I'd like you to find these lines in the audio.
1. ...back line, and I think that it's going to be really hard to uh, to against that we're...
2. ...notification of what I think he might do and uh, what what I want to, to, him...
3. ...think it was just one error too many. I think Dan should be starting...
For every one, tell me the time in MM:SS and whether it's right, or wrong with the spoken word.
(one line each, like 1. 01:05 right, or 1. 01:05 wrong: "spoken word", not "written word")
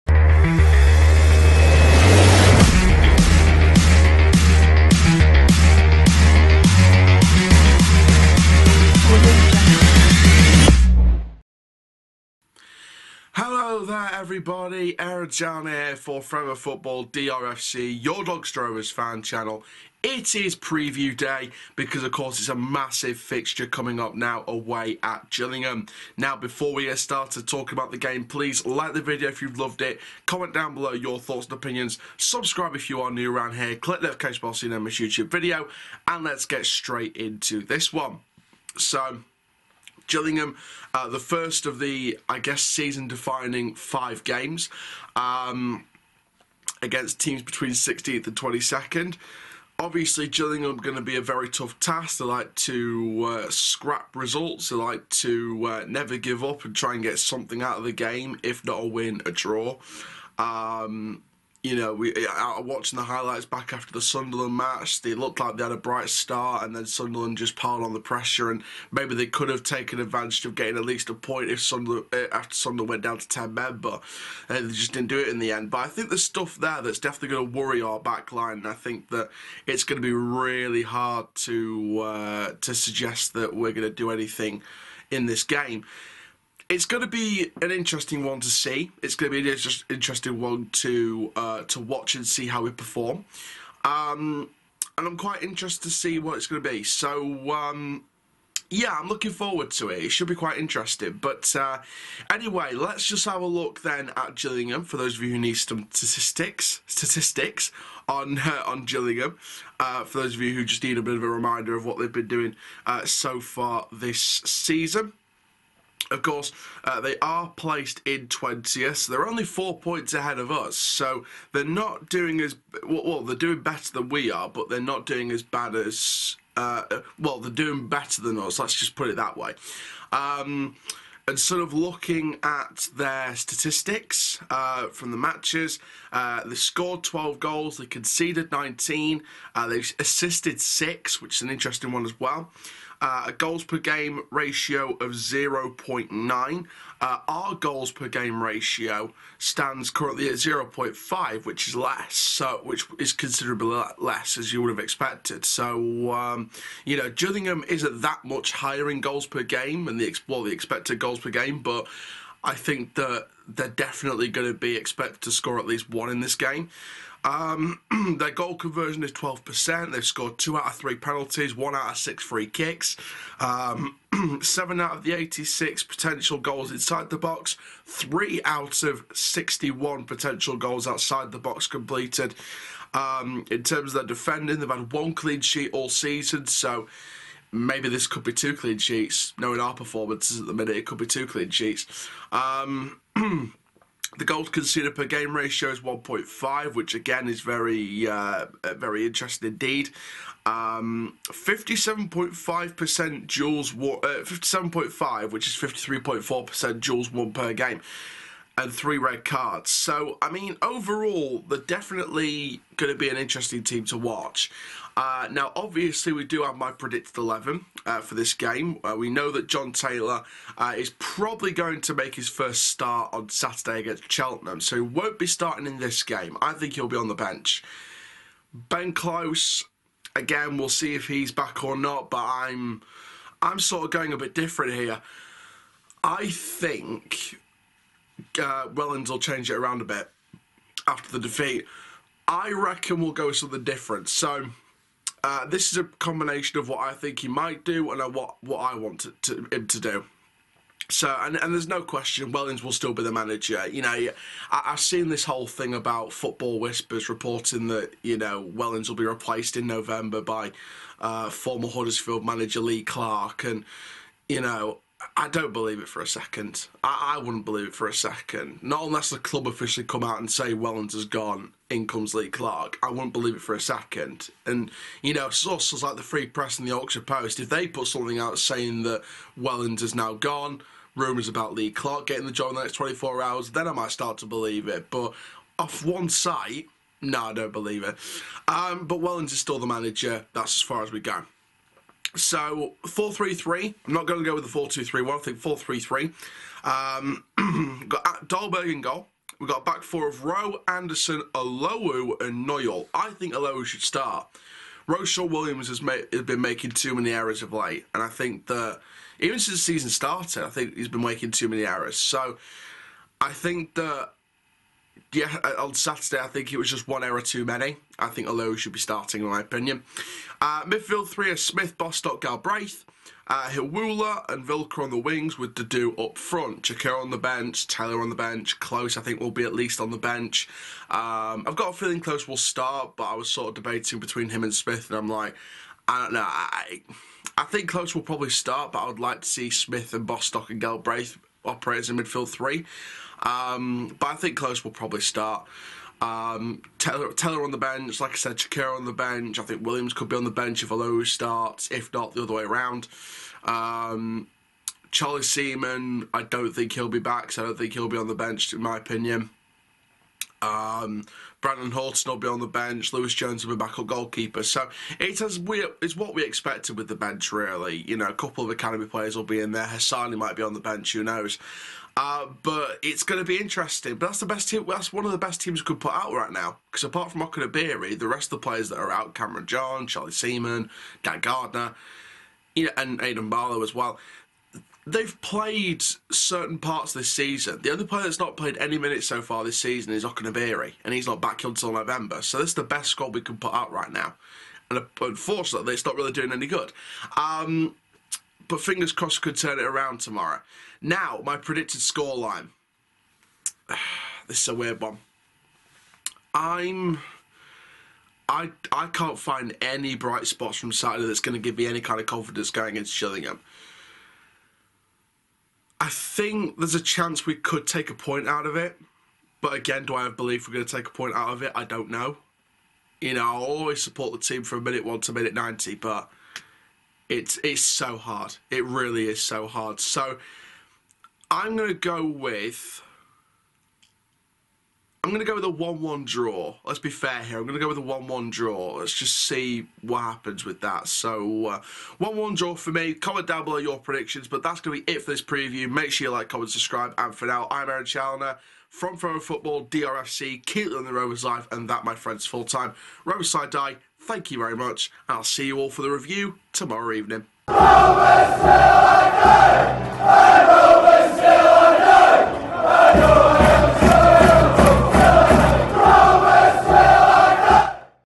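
1. 01:17 wrong: "suggest", not "against"
2. 04:05 wrong: "combination", not "notification"
3. 05:16 wrong: "Olowu", not "Dan".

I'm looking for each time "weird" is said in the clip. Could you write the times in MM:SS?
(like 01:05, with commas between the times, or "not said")
06:44.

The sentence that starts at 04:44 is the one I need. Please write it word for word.
But off one site, no, I don't believe it.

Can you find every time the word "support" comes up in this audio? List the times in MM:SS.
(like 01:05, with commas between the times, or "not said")
07:03.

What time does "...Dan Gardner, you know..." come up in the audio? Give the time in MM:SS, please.
06:21.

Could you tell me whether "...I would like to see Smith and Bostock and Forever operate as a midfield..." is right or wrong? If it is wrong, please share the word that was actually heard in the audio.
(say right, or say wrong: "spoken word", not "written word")
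wrong: "Galbraith", not "Forever".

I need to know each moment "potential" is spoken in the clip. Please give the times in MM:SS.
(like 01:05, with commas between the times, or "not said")
02:55, 03:00.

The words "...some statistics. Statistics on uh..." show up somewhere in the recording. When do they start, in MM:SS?
01:45.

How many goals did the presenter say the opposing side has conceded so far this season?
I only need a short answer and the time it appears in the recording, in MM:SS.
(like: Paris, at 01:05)
19, at 02:17.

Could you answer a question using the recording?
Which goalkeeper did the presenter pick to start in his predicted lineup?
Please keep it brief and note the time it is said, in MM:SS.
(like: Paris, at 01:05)
Dahlberg, at 04:58.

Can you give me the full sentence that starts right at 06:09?
Hassani might be on the bench.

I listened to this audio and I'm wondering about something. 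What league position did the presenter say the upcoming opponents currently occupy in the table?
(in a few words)
20th.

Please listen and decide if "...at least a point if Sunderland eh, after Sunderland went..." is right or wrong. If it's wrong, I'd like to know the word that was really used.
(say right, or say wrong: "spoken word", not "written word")
right.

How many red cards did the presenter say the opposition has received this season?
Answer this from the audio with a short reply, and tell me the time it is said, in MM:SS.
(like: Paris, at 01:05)
3, at 03:28.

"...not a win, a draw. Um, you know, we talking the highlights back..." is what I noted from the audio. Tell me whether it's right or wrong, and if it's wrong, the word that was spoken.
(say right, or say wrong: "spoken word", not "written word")
wrong: "watching", not "talking".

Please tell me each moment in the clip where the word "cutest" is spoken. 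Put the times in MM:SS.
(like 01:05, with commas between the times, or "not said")
not said.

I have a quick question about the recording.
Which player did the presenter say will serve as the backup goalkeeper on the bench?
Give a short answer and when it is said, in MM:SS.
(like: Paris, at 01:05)
Lewis Jones, at 06:02.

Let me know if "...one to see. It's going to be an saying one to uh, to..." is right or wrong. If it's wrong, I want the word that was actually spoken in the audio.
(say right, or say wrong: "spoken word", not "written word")
wrong: "interesting", not "saying".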